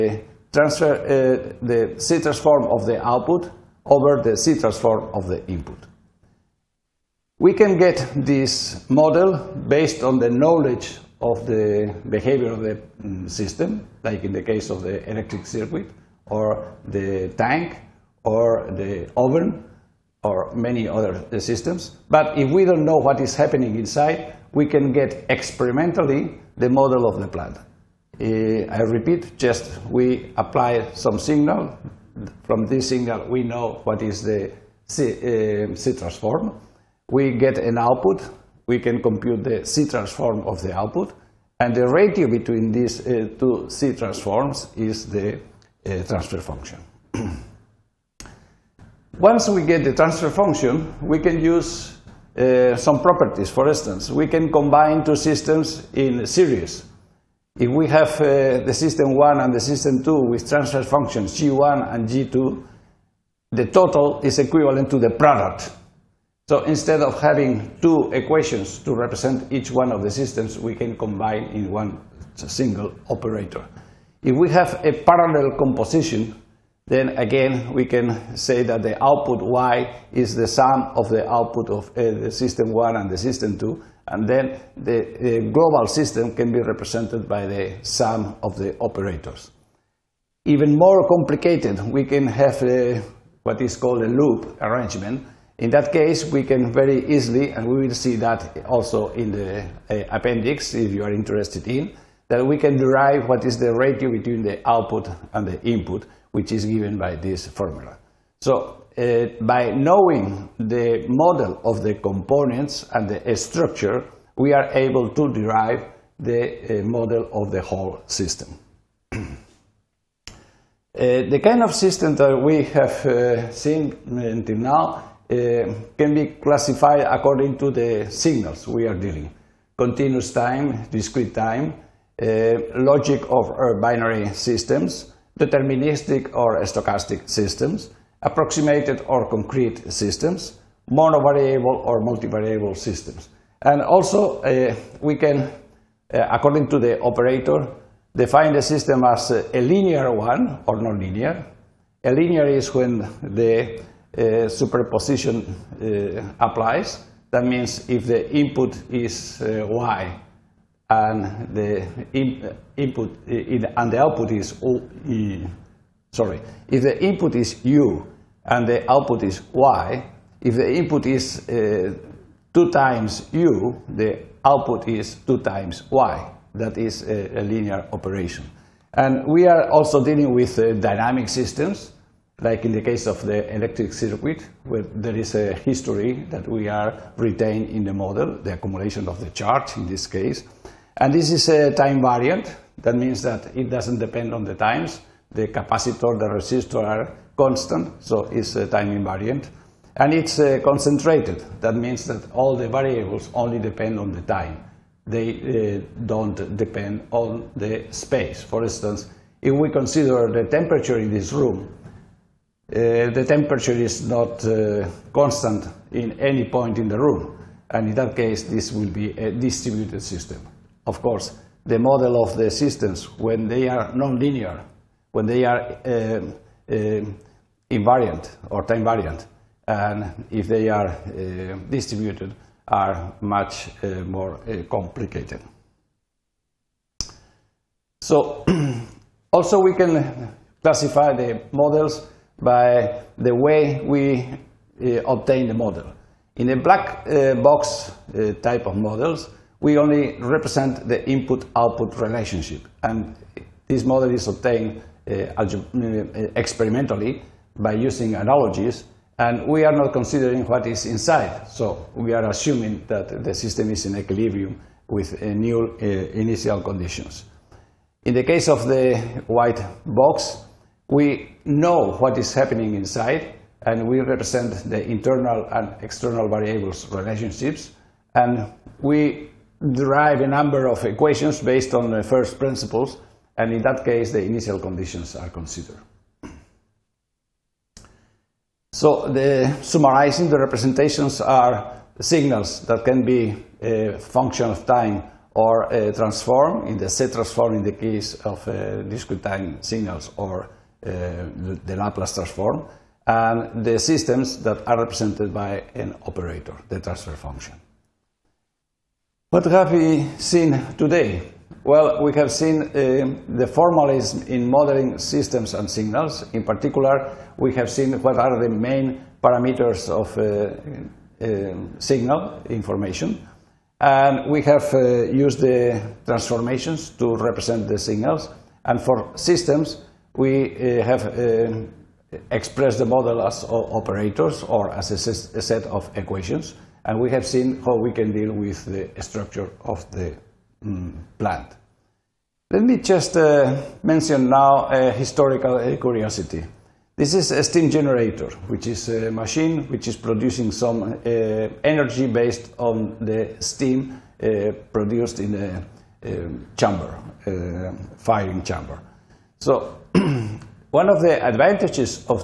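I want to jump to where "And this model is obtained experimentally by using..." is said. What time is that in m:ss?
4:12.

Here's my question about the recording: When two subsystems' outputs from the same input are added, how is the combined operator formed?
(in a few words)
Sum of the operators.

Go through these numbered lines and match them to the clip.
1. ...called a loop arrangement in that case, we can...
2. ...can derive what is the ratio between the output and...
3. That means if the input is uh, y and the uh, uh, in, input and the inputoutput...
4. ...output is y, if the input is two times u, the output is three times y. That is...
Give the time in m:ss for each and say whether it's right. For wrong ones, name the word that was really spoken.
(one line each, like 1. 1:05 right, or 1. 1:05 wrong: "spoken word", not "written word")
1. 1:33 right
2. 1:42 right
3. 2:37 wrong: "output", not "inputoutput"
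4. 2:48 wrong: "two", not "three".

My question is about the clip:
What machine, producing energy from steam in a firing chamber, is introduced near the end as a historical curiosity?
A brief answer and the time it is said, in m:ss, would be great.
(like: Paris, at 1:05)
Steam generator, at 5:47.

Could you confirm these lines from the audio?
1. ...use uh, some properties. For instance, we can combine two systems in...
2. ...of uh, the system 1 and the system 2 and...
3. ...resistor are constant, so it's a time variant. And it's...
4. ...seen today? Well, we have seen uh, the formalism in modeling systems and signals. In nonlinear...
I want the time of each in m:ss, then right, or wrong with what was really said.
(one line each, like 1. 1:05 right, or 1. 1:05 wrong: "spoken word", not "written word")
1. 0:51 right
2. 1:21 right
3. 3:16 wrong: "invariant", not "variant"
4. 5:10 wrong: "particular", not "nonlinear".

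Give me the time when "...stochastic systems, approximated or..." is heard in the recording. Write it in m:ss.
2:16.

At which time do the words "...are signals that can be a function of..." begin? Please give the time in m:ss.
4:51.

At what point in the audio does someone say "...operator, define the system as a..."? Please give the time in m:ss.
2:27.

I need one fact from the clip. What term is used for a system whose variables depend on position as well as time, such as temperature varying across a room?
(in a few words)
Distributed system.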